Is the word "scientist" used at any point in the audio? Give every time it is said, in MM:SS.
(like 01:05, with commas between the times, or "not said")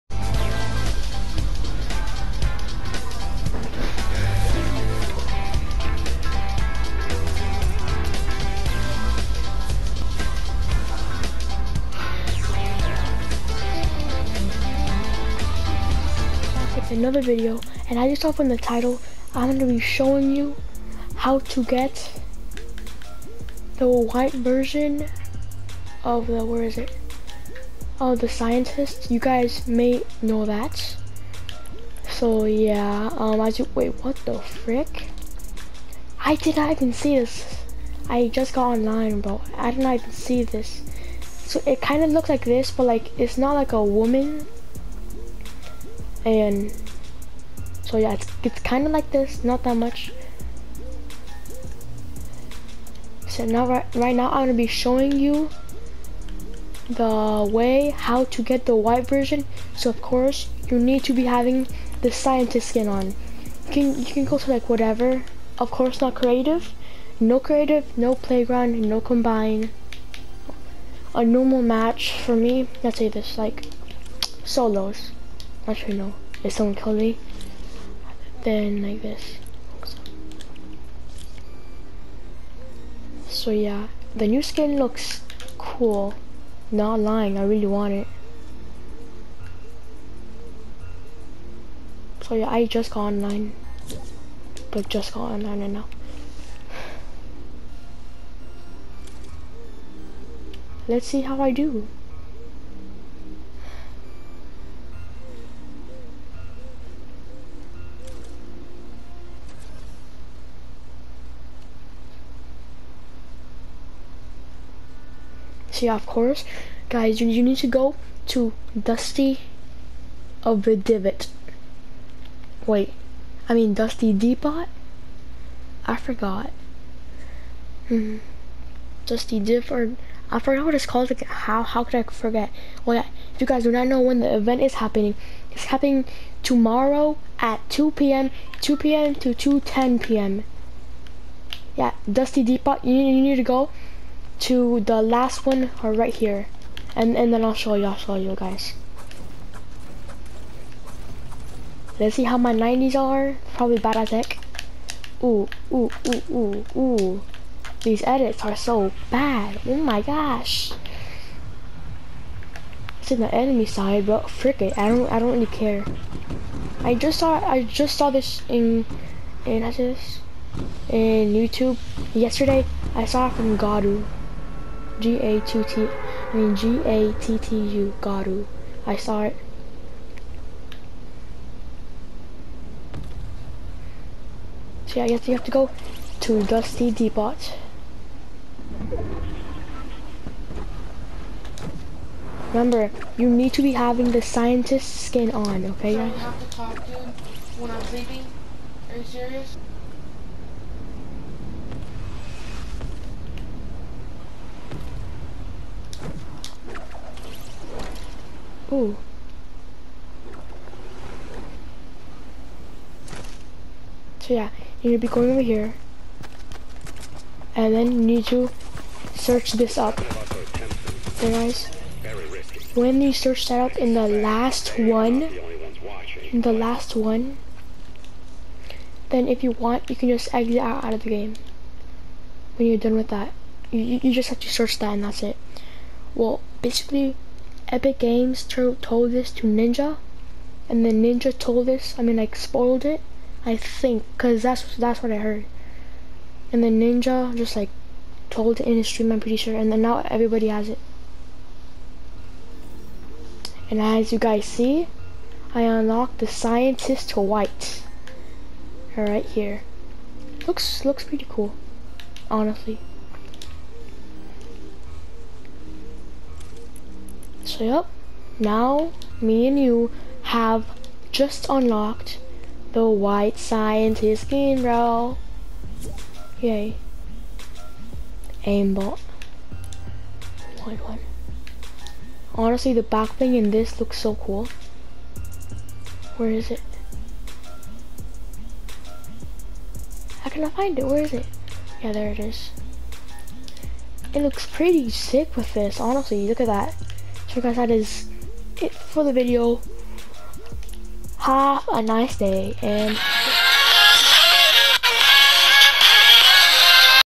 00:28, 01:02, 03:14, 04:16, 04:33.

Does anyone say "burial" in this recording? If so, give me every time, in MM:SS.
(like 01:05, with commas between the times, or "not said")
not said.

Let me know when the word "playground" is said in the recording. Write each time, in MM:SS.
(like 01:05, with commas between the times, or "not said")
01:08.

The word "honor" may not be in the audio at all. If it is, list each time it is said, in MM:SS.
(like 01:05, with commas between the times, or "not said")
not said.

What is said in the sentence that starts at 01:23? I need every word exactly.
yeah, the new skin looks cool.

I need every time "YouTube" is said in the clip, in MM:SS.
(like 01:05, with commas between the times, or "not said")
02:51.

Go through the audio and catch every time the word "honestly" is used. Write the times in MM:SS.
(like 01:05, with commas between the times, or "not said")
04:22, 04:42, 04:55.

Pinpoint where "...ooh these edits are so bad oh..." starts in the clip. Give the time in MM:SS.
02:36.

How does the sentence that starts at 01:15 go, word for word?
Actually no, if someone killed me, then like this.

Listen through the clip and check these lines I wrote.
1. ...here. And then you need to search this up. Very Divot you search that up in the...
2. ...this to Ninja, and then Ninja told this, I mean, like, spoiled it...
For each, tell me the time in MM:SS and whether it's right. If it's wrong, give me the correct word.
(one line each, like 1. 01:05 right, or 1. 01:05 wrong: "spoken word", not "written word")
1. 03:35 wrong: "When", not "Divot"
2. 03:59 right.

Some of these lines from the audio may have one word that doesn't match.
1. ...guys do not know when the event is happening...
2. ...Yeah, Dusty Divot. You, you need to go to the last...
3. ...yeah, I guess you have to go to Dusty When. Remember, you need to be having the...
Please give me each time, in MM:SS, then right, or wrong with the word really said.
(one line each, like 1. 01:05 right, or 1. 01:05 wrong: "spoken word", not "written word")
1. 02:13 right
2. 02:21 wrong: "Depot", not "Divot"
3. 03:04 wrong: "Depot", not "When".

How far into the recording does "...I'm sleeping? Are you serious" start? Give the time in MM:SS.
03:17.